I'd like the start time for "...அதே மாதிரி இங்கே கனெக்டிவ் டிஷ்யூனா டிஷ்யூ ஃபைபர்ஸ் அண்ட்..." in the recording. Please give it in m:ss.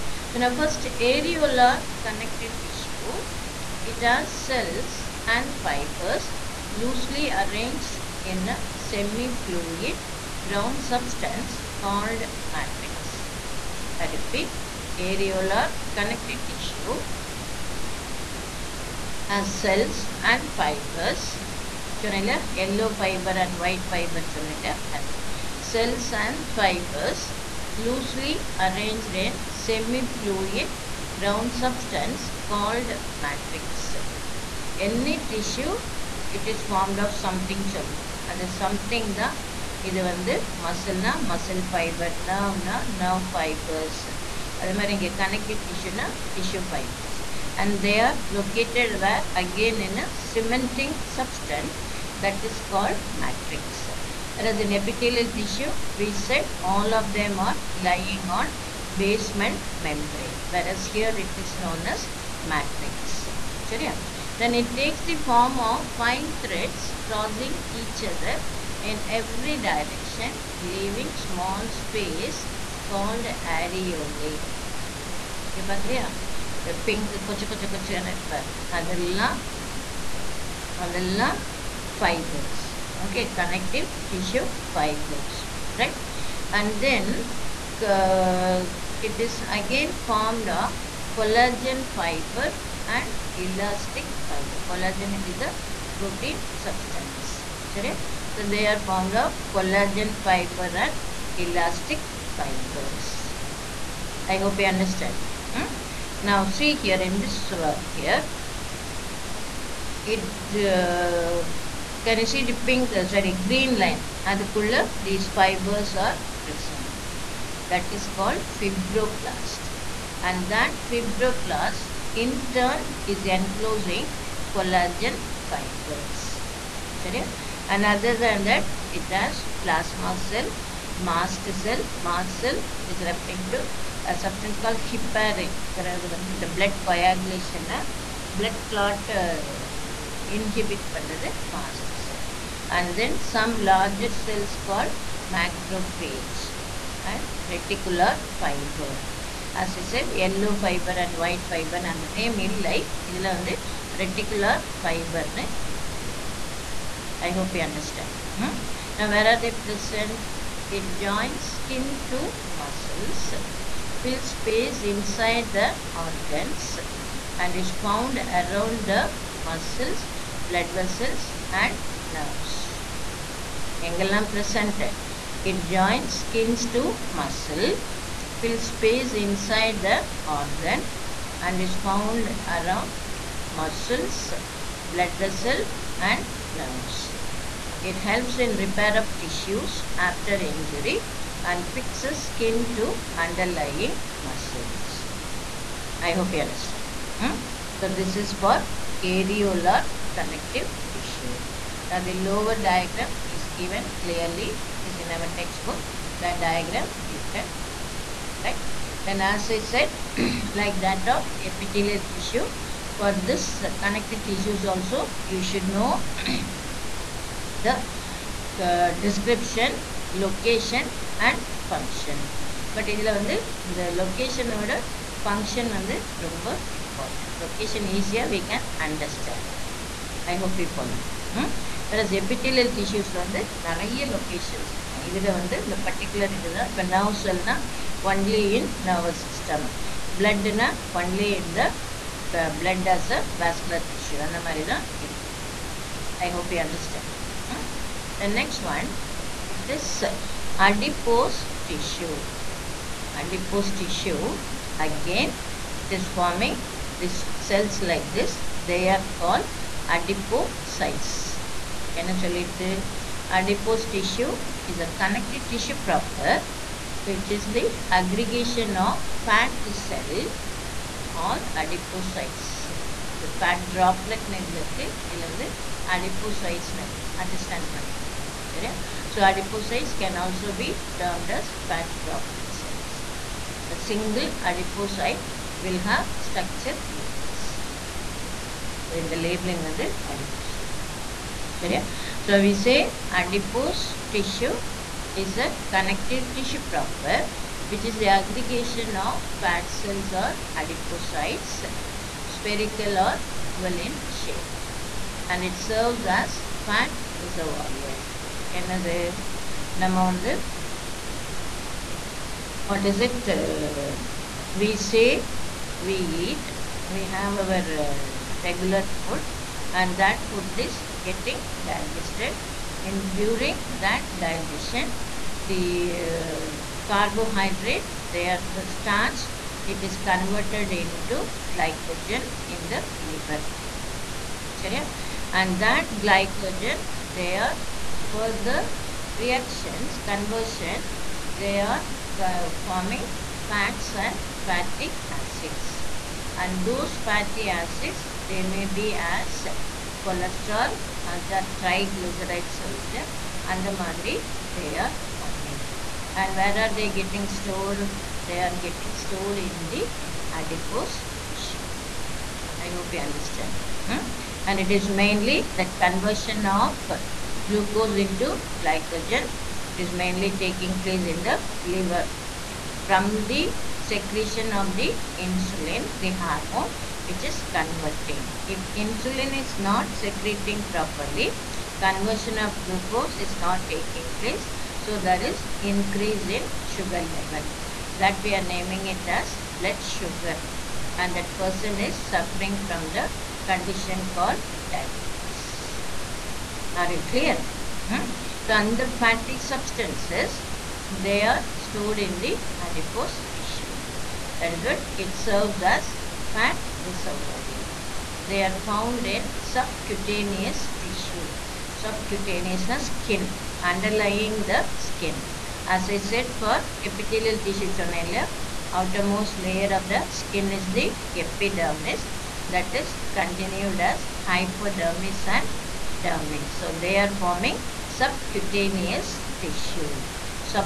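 0:44.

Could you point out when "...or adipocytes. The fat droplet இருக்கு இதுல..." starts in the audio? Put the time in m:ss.
4:31.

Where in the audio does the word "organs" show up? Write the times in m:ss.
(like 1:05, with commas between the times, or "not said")
2:46, 3:00.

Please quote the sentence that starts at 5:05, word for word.
And it serves as fat reservoir.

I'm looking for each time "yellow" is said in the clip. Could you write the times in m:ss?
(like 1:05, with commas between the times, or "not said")
0:22, 2:30.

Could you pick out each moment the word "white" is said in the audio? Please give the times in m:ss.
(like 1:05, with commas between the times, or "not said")
0:23, 2:31.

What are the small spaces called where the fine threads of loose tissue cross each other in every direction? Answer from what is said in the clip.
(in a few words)
areole.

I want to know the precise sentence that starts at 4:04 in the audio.
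and மாதிரி I hope you understand.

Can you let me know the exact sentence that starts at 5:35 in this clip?
And that glycogen, they are further reactions, conversion, they are uh, forming fats and fatty acids.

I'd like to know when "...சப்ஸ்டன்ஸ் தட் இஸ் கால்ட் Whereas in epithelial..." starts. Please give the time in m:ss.
0:51.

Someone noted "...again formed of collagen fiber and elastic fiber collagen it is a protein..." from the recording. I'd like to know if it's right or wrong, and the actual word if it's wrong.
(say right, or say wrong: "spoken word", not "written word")
right.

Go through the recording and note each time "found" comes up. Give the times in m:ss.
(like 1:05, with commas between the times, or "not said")
2:47, 3:01, 6:48.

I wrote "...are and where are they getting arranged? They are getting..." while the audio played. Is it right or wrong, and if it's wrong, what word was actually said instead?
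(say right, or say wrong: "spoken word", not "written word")
wrong: "stored", not "arranged".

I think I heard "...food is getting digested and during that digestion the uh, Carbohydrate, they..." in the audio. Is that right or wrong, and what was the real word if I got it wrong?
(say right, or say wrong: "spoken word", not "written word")
right.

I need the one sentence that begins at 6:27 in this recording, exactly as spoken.
That we are naming it as blood sugar.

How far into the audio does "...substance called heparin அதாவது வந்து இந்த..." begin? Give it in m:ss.
2:14.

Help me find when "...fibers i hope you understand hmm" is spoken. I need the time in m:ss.
1:42.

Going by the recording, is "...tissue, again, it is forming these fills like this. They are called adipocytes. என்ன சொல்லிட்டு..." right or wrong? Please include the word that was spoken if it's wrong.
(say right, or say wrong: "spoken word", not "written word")
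wrong: "cells", not "fills".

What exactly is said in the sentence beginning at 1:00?
Whereas here it is known as matrix.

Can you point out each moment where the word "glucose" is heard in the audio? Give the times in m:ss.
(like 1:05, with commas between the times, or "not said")
6:07, 6:22.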